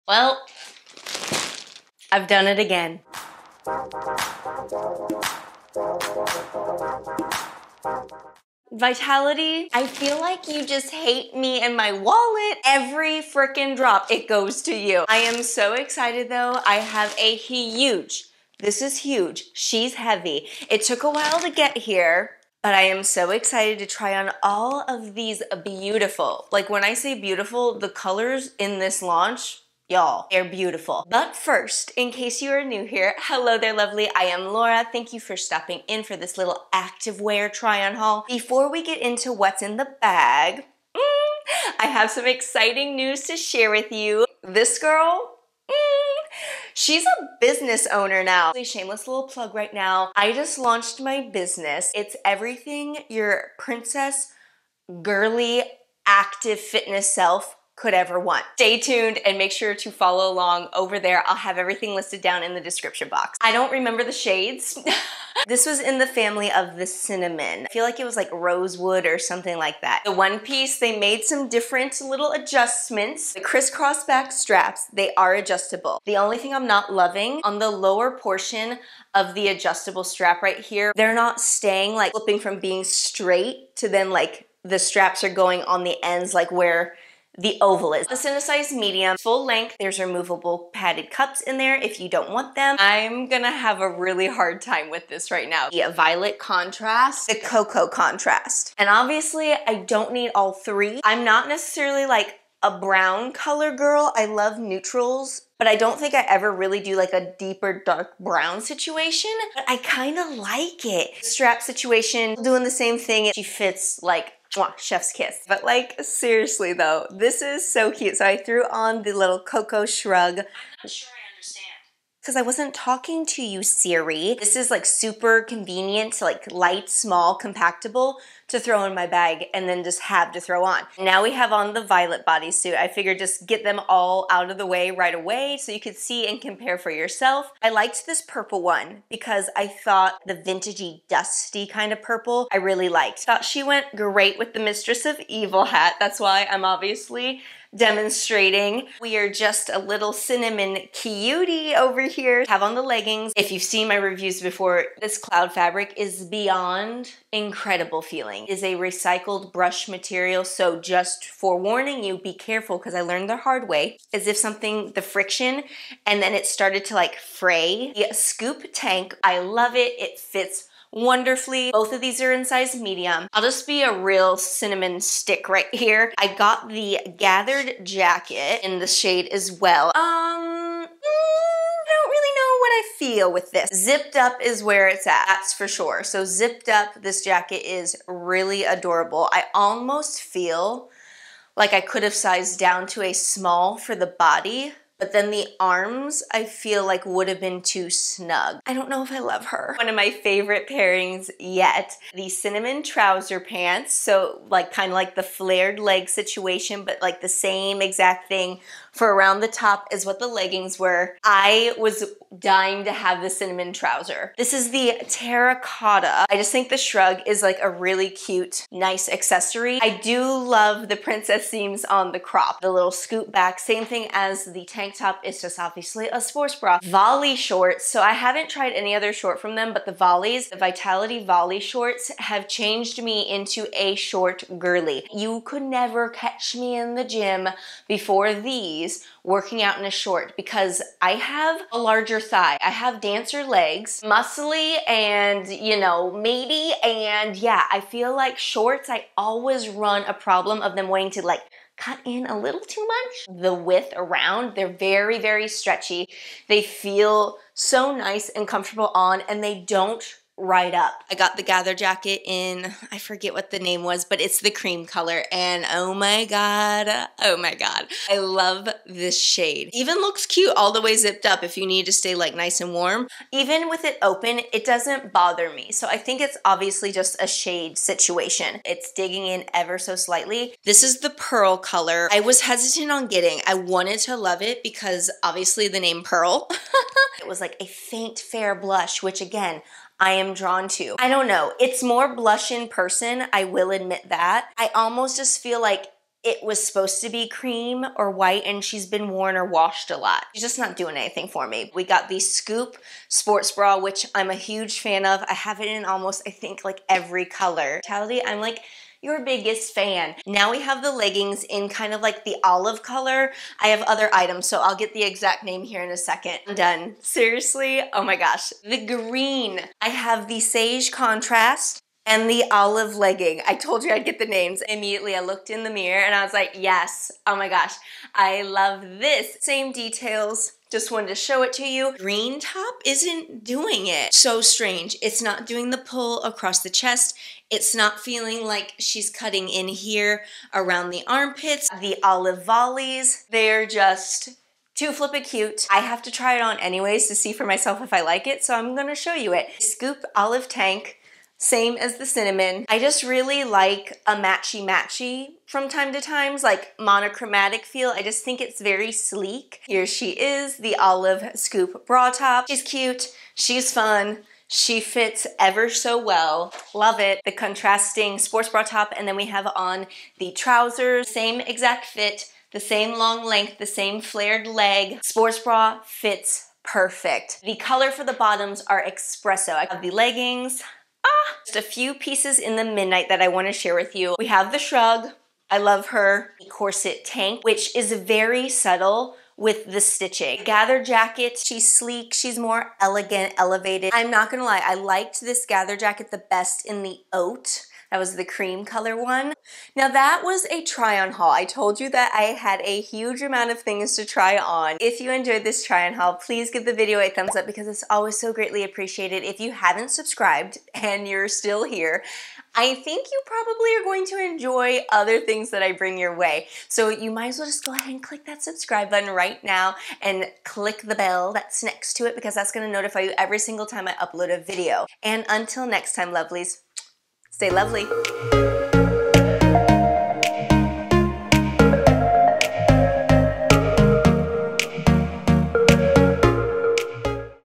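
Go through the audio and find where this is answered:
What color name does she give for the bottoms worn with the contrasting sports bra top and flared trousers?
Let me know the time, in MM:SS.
06:18.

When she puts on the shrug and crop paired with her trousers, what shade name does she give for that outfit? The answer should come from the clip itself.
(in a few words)
terracotta.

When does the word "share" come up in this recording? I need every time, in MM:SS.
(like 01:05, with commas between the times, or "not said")
00:43, 06:23.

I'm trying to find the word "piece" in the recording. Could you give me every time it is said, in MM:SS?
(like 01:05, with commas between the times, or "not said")
01:10, 06:21.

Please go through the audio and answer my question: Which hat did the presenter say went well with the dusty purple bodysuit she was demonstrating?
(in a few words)
Mistress of Evil.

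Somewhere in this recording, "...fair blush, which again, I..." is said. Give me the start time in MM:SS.
04:48.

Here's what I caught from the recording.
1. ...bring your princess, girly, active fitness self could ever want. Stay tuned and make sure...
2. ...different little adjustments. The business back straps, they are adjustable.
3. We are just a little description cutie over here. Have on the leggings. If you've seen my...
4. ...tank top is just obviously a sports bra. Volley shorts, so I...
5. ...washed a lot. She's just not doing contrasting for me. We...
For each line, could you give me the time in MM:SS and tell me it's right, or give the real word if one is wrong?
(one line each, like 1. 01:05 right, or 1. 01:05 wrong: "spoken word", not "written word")
1. 00:52 wrong: "everything", not "bring"
2. 01:11 wrong: "crisscross", not "business"
3. 02:28 wrong: "cinnamon", not "description"
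4. 03:44 right
5. 04:59 wrong: "anything", not "contrasting".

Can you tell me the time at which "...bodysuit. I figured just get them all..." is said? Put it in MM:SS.
02:12.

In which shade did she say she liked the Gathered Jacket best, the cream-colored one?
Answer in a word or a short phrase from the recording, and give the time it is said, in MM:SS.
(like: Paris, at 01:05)
oat, at 06:37.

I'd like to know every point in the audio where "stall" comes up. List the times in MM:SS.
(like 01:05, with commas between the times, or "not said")
not said.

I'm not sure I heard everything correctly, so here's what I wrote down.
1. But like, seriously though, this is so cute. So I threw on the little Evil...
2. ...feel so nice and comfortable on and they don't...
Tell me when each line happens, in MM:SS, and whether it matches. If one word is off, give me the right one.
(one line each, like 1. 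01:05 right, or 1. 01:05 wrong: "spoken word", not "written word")
1. 01:55 wrong: "Cocoa", not "Evil"
2. 04:16 right.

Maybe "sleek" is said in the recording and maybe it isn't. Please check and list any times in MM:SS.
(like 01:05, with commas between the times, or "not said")
05:58, 06:31.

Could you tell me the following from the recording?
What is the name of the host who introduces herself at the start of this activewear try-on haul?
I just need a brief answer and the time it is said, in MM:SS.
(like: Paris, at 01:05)
Laura, at 00:34.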